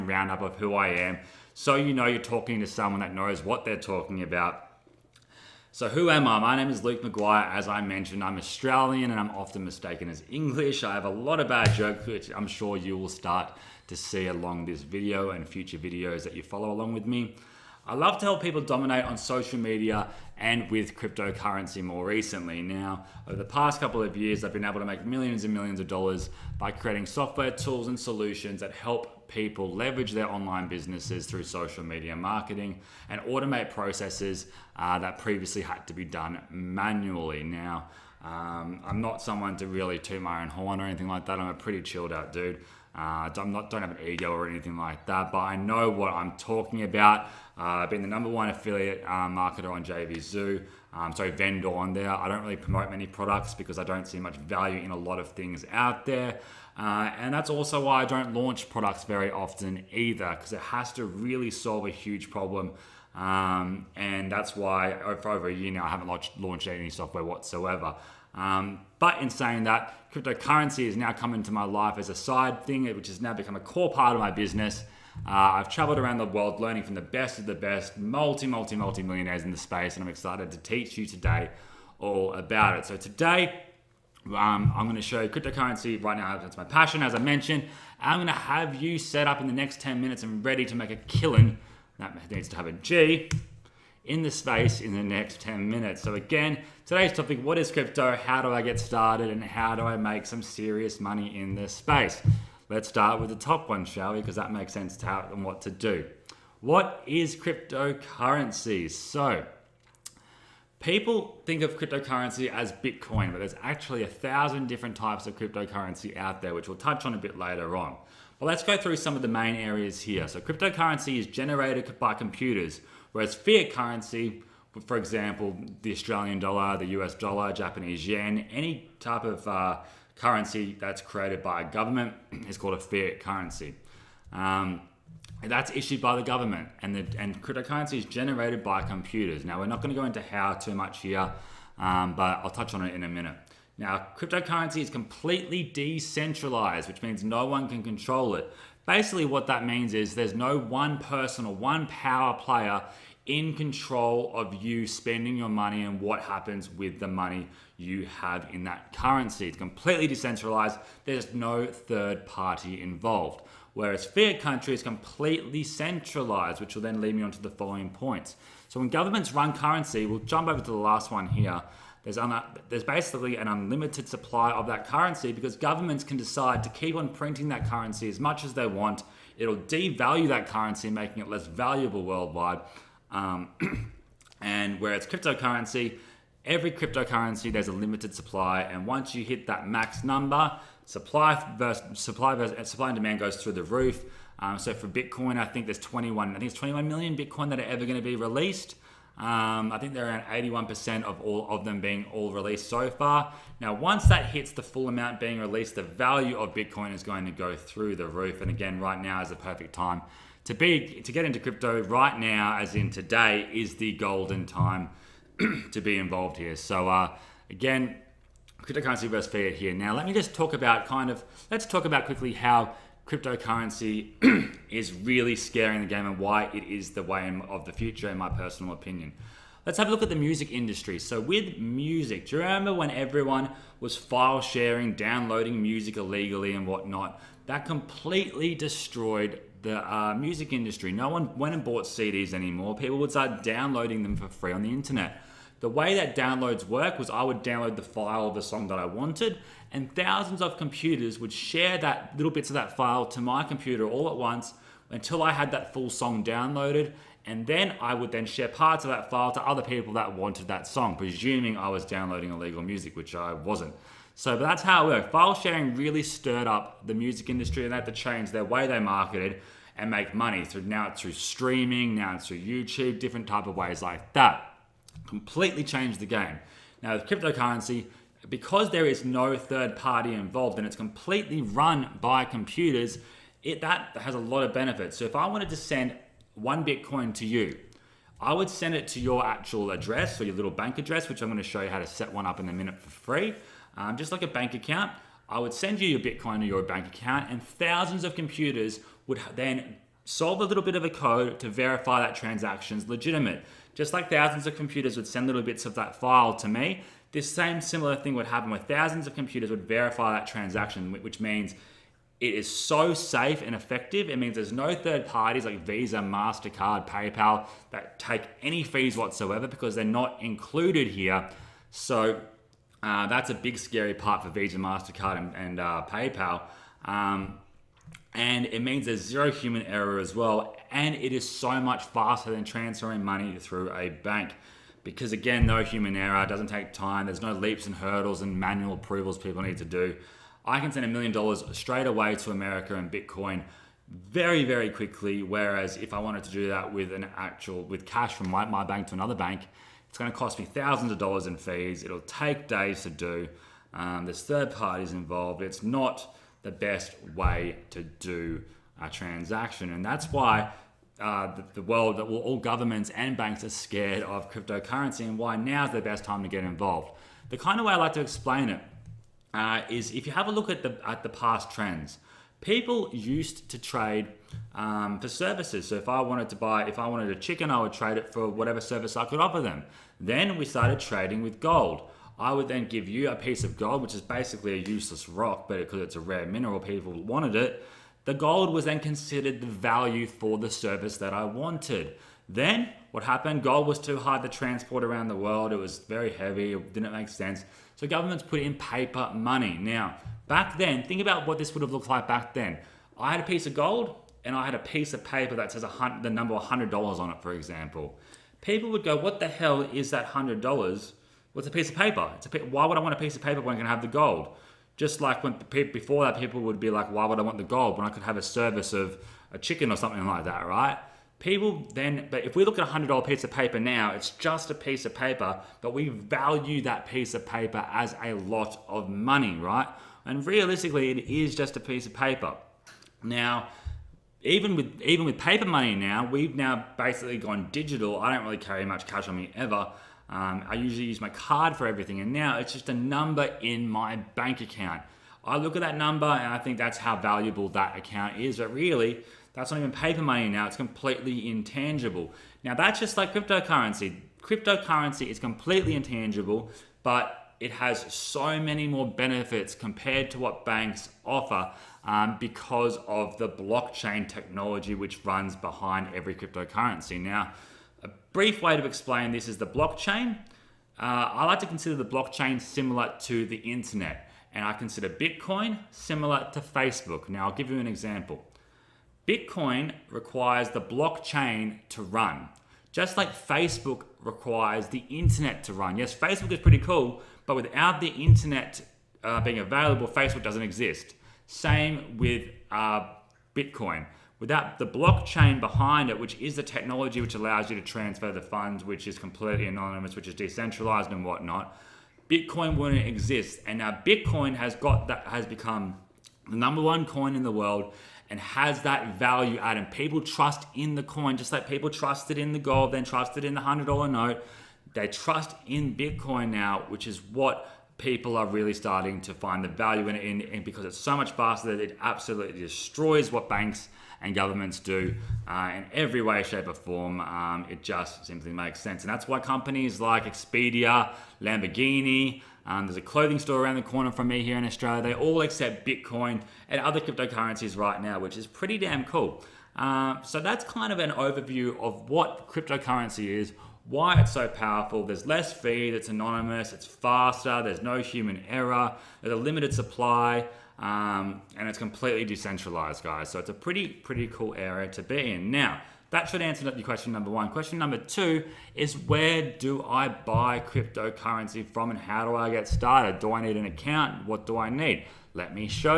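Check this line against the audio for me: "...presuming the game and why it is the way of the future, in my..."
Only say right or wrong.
wrong.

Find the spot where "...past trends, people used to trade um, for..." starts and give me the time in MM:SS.
06:11.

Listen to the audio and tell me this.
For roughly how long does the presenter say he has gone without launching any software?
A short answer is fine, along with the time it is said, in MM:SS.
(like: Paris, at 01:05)
over a year, at 01:05.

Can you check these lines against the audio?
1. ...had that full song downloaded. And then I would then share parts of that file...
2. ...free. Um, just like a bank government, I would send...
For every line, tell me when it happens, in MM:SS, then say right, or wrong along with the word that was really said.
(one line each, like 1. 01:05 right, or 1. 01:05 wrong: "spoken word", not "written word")
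1. 04:15 right
2. 04:52 wrong: "account", not "government".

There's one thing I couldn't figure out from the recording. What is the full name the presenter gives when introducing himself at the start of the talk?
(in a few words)
Luke McGuire.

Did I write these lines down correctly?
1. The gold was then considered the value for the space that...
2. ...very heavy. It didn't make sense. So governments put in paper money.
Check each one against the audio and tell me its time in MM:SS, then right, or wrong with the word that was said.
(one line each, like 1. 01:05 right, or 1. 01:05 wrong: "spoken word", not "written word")
1. 06:28 wrong: "service", not "space"
2. 06:35 right.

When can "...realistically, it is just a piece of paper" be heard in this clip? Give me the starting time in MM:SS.
07:10.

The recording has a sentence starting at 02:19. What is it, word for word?
Now we're not going to go into how too much here, um, but I'll touch on it in a minute.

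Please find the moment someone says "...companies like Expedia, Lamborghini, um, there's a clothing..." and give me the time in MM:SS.
08:49.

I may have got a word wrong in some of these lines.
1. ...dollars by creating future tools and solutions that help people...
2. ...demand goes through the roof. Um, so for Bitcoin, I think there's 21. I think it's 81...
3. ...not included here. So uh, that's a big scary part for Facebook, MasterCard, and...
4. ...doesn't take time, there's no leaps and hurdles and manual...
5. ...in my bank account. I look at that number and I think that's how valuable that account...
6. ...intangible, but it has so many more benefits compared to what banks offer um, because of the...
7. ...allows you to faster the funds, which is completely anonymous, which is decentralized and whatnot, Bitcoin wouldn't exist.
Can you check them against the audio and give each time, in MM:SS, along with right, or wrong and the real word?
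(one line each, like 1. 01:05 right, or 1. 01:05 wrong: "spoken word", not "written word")
1. 00:25 wrong: "software", not "future"
2. 03:12 wrong: "21", not "81"
3. 05:19 wrong: "Visa", not "Facebook"
4. 05:36 right
5. 07:23 right
6. 07:35 right
7. 08:17 wrong: "transfer", not "faster".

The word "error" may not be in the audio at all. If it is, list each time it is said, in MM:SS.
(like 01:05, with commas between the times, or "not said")
05:29, 05:35, 09:08.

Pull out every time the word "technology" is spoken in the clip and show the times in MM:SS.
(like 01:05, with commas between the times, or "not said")
07:44, 08:16.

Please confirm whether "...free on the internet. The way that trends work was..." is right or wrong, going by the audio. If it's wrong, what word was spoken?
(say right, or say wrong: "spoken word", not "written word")
wrong: "downloads", not "trends".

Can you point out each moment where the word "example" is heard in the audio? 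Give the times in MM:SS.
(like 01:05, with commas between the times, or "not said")
02:04, 06:47, 07:57.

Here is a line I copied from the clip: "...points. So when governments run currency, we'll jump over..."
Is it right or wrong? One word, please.
right.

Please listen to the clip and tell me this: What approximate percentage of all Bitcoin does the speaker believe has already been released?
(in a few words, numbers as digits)
81%.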